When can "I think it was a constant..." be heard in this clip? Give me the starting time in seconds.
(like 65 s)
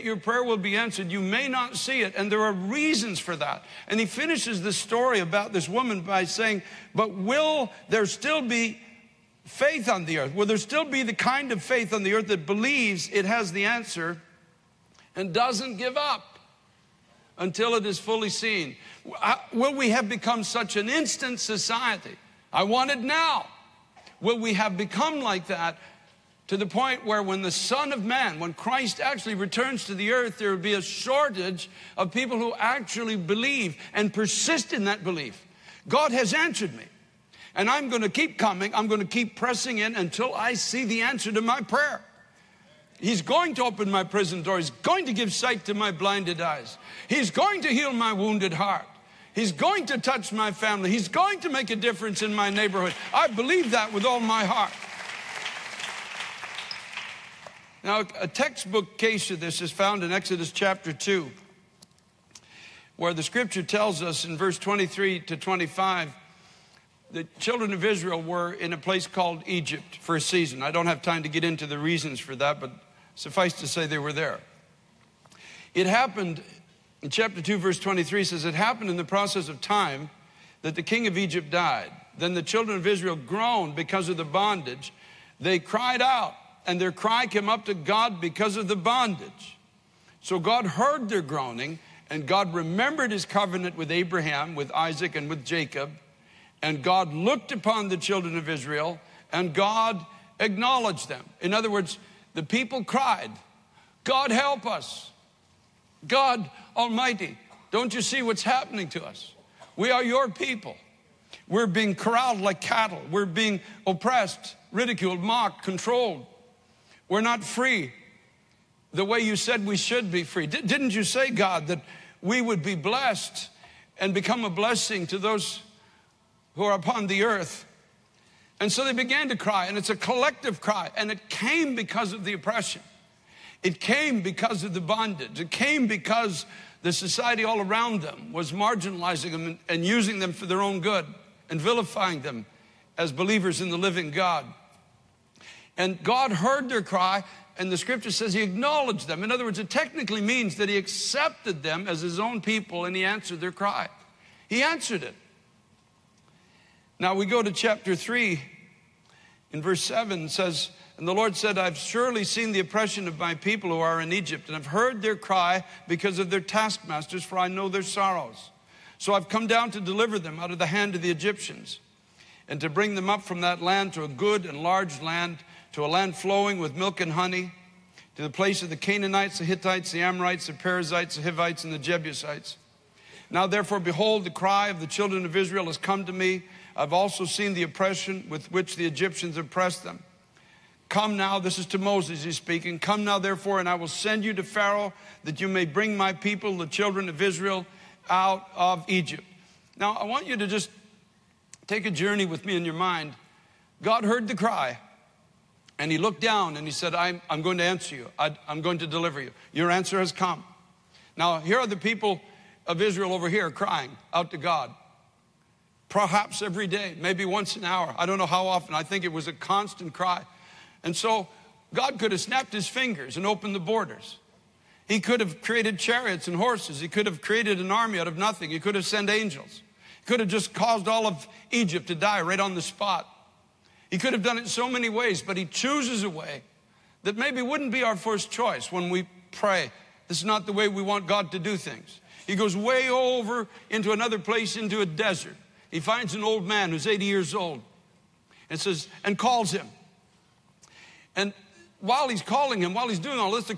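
218 s.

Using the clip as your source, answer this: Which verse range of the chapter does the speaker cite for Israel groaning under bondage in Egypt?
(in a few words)
23 to 25.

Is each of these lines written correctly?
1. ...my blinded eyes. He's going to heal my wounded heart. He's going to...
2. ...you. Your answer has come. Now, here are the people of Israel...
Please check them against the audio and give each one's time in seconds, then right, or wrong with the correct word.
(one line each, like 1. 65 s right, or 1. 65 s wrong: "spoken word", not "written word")
1. 45 s right
2. 209 s right.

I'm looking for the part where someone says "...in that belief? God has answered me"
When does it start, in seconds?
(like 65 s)
34 s.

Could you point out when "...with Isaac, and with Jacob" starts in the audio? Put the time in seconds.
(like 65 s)
94 s.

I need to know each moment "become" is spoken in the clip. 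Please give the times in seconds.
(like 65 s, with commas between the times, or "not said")
20 s, 24 s, 124 s.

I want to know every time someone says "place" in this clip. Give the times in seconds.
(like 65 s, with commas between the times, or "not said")
68 s, 178 s, 244 s.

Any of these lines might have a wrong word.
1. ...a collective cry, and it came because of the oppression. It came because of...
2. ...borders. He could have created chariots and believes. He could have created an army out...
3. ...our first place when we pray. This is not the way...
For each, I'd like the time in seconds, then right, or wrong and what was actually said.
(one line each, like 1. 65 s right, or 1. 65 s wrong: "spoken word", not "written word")
1. 129 s right
2. 223 s wrong: "horses", not "believes"
3. 237 s wrong: "choice", not "place".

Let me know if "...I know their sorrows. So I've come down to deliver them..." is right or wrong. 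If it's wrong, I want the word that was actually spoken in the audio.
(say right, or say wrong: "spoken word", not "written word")
right.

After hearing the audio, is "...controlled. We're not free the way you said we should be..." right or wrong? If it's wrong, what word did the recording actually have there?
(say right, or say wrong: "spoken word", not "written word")
right.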